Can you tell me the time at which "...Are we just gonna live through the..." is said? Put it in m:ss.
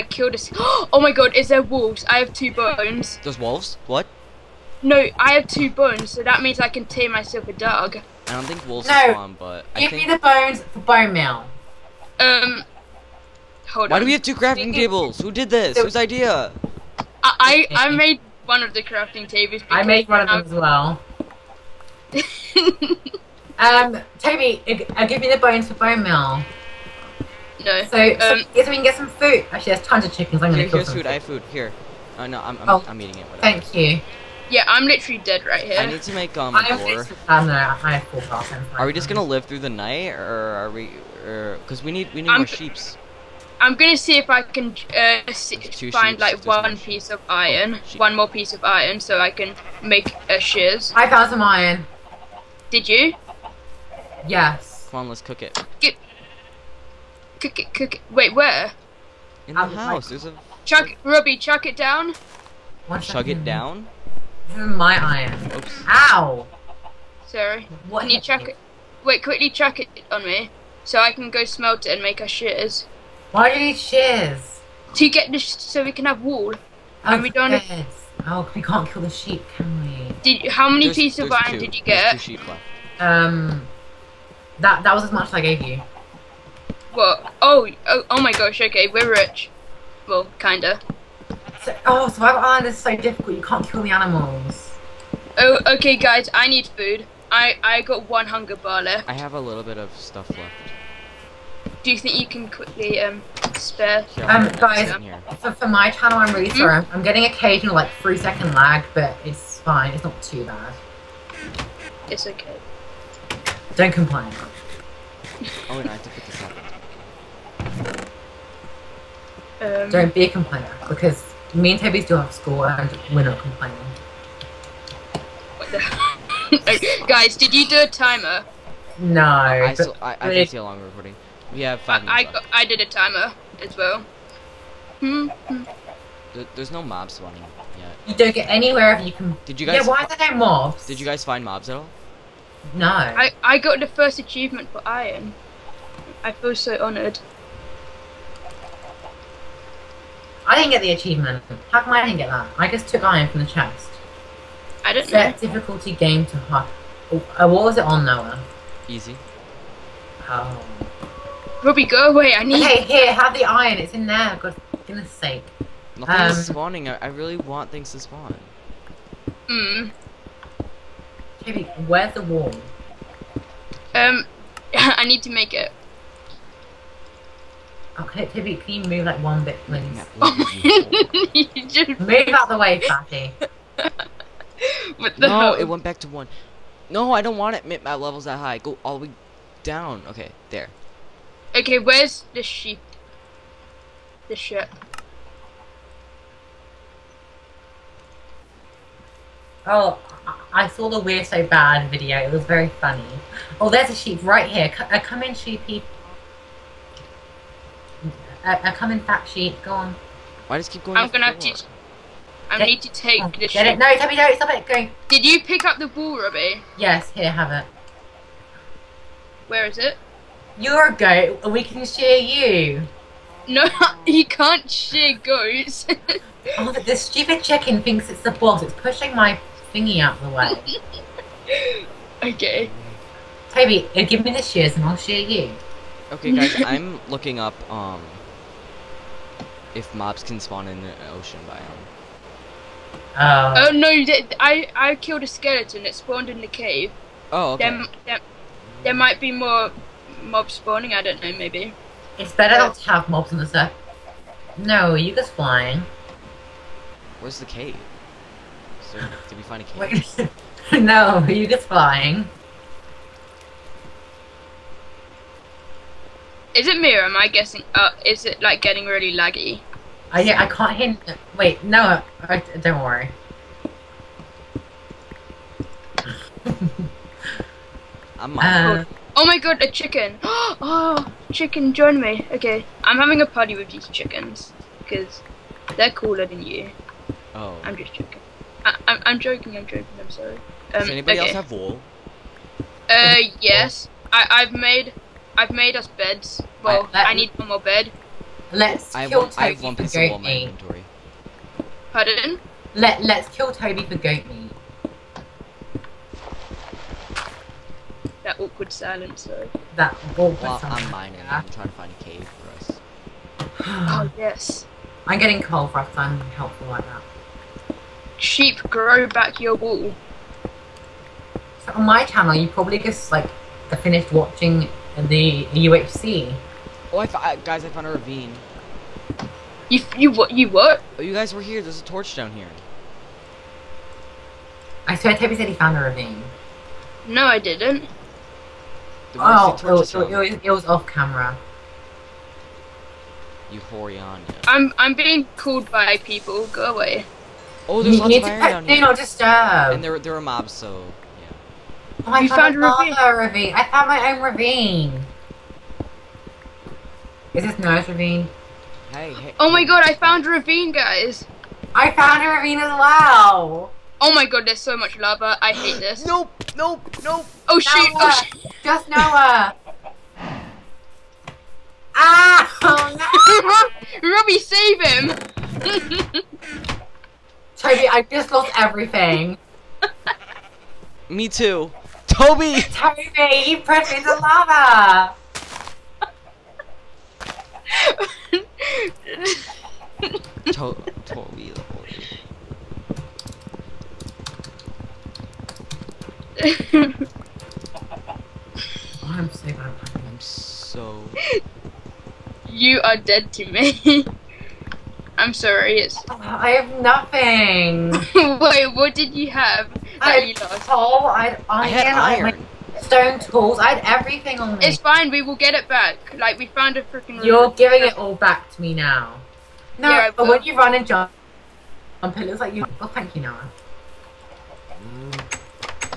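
0:38.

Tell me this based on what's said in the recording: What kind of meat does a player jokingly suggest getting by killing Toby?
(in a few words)
Goat meat.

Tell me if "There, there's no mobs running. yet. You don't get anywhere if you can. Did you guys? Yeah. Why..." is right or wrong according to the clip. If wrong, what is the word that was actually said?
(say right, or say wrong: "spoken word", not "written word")
right.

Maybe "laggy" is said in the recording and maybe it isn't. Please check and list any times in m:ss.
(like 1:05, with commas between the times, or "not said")
4:29.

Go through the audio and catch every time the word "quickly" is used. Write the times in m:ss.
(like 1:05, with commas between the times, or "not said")
1:09, 1:42.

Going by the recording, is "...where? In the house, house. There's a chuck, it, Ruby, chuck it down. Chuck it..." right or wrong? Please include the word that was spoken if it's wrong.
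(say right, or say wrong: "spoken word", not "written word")
right.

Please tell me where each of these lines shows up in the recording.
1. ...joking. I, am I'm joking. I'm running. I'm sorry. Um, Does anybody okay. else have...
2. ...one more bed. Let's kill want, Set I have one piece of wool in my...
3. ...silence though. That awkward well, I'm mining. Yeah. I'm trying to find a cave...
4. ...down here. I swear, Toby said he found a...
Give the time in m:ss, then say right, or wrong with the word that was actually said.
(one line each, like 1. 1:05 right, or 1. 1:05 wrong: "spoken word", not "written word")
1. 4:47 wrong: "joking", not "running"
2. 4:57 wrong: "Toby", not "Set"
3. 5:08 right
4. 5:32 right.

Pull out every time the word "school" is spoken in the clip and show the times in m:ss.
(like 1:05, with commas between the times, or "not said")
0:38, 2:02.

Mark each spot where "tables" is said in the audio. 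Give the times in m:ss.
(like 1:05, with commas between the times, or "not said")
0:14, 0:19.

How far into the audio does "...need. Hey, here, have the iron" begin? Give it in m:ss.
2:42.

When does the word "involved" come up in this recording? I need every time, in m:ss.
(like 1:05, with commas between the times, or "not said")
not said.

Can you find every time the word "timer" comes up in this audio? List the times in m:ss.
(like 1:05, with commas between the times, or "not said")
2:07, 2:12.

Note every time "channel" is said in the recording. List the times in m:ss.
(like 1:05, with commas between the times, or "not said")
1:45, 5:22.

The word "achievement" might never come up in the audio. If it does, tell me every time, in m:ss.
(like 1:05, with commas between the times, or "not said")
2:24, 2:30.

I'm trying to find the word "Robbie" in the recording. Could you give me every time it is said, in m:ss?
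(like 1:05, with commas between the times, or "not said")
3:36, 6:14.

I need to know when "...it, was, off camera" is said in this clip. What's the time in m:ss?
5:40.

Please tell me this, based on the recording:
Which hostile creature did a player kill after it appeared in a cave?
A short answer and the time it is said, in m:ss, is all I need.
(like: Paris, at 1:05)
Skeleton, at 4:05.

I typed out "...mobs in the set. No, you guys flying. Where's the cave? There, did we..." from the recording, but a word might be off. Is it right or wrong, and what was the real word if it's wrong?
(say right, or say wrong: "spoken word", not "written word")
right.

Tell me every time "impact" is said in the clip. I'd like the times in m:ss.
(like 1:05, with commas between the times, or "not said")
not said.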